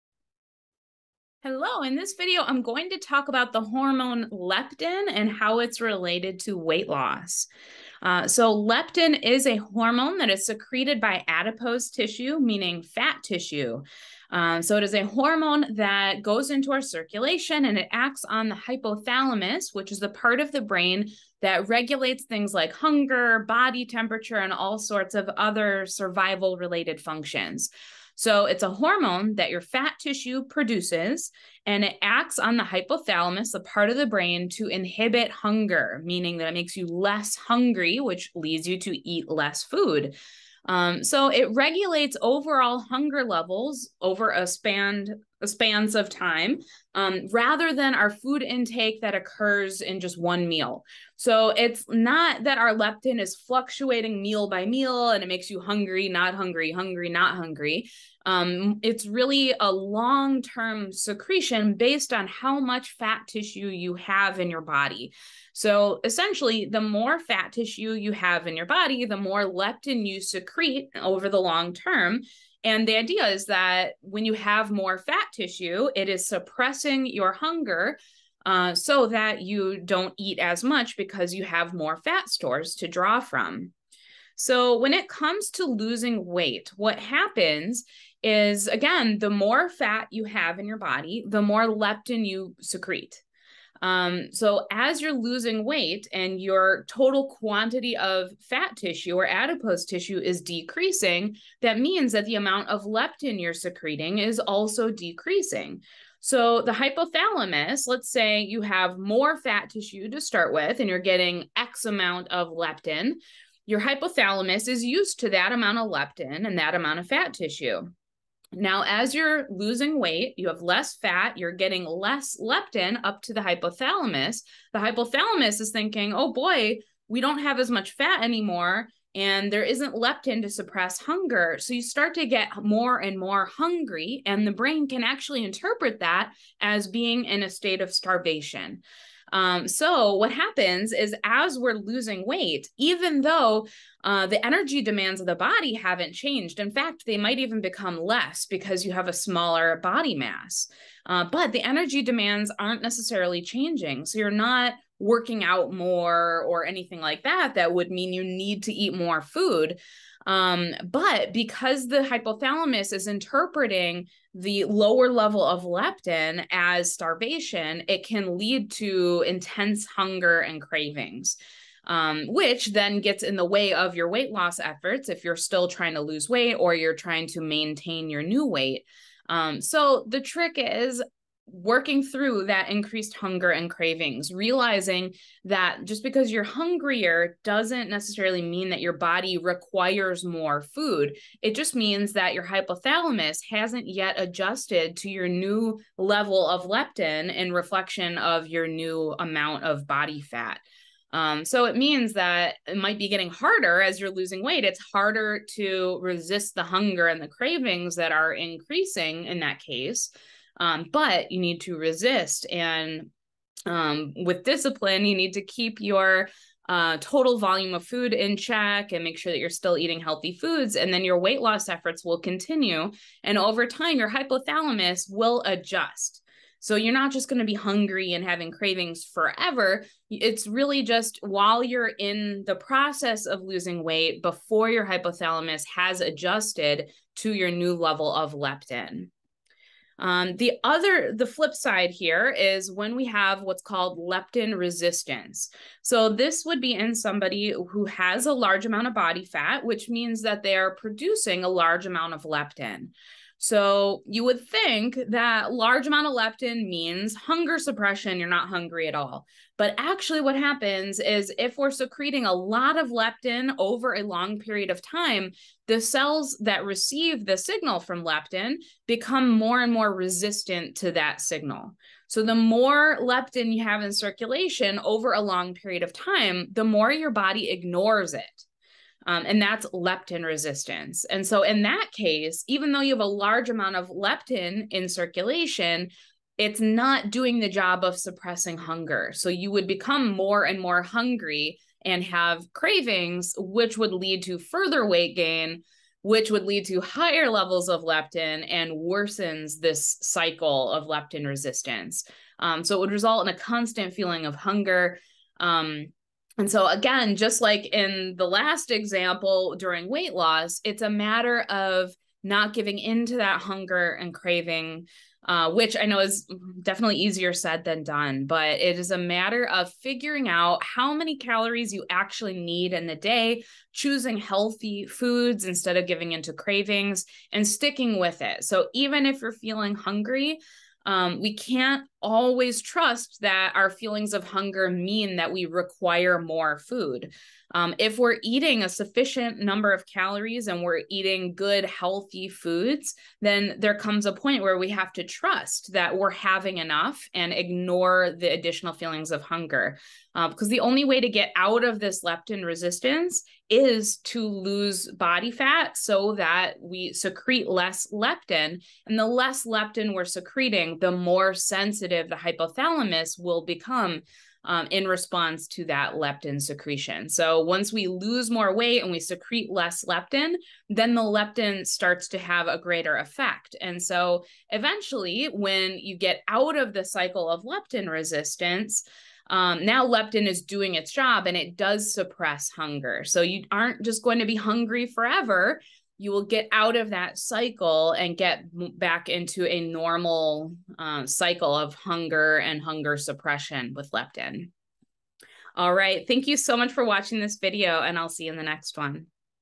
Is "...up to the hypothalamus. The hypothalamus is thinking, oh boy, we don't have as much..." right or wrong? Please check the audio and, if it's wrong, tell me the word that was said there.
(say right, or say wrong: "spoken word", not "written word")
right.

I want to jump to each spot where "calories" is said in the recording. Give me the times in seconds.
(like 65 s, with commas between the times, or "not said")
321 s, 339 s.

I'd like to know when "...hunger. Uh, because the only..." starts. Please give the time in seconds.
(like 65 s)
349 s.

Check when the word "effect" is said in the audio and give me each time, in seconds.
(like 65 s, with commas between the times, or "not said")
372 s.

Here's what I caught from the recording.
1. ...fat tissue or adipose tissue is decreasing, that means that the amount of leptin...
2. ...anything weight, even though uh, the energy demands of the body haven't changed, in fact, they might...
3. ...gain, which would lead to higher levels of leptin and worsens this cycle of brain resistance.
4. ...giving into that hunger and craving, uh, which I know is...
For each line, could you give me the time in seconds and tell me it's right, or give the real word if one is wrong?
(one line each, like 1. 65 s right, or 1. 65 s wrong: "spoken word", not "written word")
1. 98 s right
2. 141 s wrong: "losing", not "anything"
3. 295 s wrong: "leptin", not "brain"
4. 312 s right.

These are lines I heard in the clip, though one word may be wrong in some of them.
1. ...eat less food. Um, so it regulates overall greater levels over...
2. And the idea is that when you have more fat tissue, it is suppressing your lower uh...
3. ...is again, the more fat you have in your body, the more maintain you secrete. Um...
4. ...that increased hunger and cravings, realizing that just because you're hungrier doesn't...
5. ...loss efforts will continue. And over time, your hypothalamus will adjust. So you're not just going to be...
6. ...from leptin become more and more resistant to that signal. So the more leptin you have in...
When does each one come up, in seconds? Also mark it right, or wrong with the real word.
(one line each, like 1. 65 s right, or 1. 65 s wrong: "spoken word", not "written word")
1. 39 s wrong: "hunger", not "greater"
2. 72 s wrong: "hunger", not "lower"
3. 88 s wrong: "leptin", not "maintain"
4. 182 s right
5. 221 s right
6. 267 s right.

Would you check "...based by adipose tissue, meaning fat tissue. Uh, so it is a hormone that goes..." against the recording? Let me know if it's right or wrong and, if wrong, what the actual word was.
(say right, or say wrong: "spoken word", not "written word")
wrong: "secreted", not "based".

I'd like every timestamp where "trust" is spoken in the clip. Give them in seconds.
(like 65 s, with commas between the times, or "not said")
332 s, 345 s.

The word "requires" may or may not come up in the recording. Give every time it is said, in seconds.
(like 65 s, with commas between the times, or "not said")
189 s, 335 s.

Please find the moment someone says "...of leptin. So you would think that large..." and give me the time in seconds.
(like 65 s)
252 s.